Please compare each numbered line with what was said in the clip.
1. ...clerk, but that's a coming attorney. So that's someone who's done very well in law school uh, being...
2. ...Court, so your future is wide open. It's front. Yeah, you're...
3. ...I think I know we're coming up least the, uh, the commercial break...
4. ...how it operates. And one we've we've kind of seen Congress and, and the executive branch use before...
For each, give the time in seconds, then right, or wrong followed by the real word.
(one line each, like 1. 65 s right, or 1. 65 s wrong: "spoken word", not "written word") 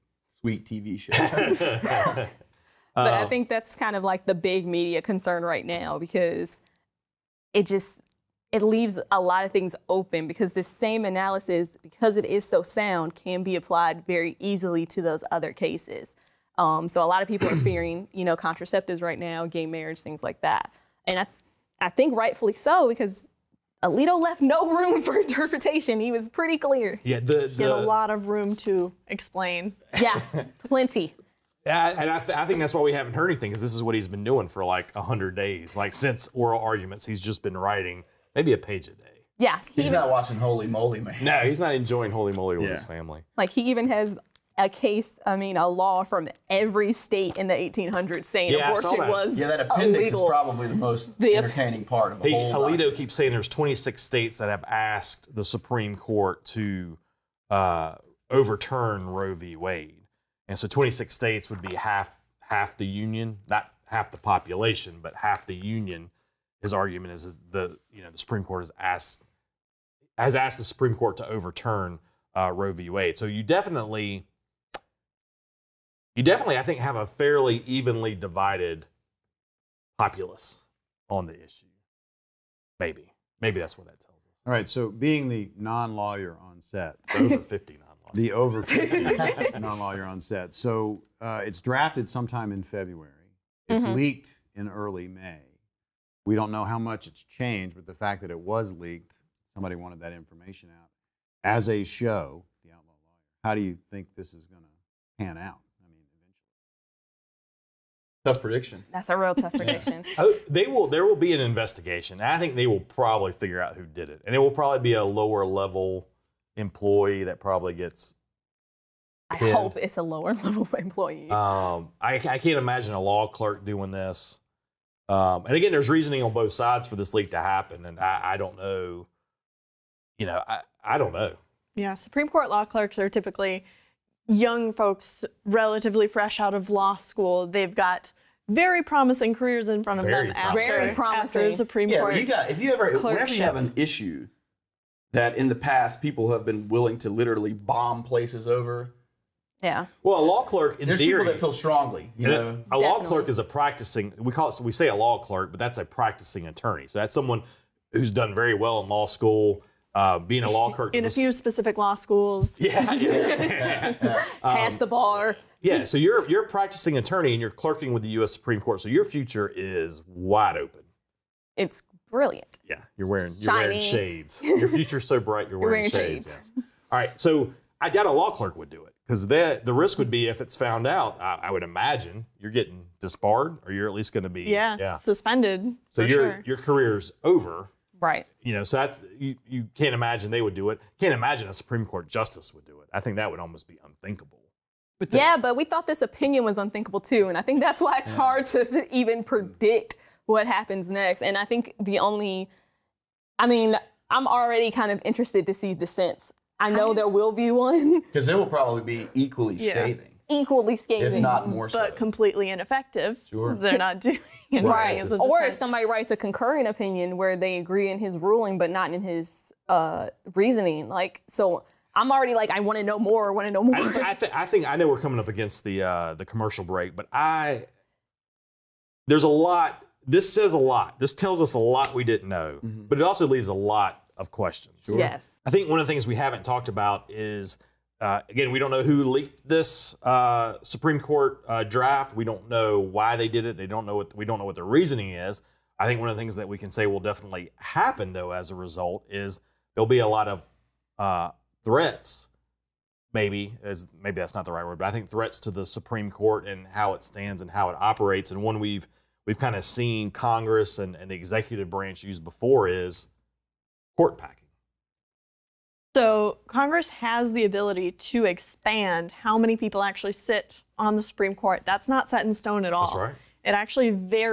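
1. 155 s wrong: "practicing", not "coming"
2. 168 s wrong: "brilliant", not "front"
3. 224 s wrong: "against", not "least"
4. 257 s right.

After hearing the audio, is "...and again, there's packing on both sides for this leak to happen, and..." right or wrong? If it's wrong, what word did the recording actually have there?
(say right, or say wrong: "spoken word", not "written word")
wrong: "reasoning", not "packing".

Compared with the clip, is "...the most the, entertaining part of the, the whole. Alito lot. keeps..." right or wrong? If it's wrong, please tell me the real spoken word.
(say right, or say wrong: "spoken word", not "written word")
right.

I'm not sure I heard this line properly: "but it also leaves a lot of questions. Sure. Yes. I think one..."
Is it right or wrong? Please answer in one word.
right.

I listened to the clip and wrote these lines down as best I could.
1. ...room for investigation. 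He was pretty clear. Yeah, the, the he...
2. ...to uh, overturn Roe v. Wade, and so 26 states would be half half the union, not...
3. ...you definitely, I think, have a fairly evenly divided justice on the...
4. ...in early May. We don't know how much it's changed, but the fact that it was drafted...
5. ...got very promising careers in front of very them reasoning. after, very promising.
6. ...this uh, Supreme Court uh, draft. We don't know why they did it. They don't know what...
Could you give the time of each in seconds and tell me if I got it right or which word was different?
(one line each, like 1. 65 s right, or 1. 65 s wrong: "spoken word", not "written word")
1. 24 s wrong: "interpretation", not "investigation"
2. 56 s right
3. 76 s wrong: "populace", not "justice"
4. 94 s wrong: "leaked", not "drafted"
5. 137 s wrong: "promising", not "reasoning"
6. 239 s right.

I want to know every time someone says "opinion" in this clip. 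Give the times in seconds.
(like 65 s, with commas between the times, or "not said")
196 s, 216 s.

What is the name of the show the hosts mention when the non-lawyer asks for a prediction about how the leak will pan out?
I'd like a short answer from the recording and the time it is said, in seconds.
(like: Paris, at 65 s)
The Outlaw Lawyer, at 102 s.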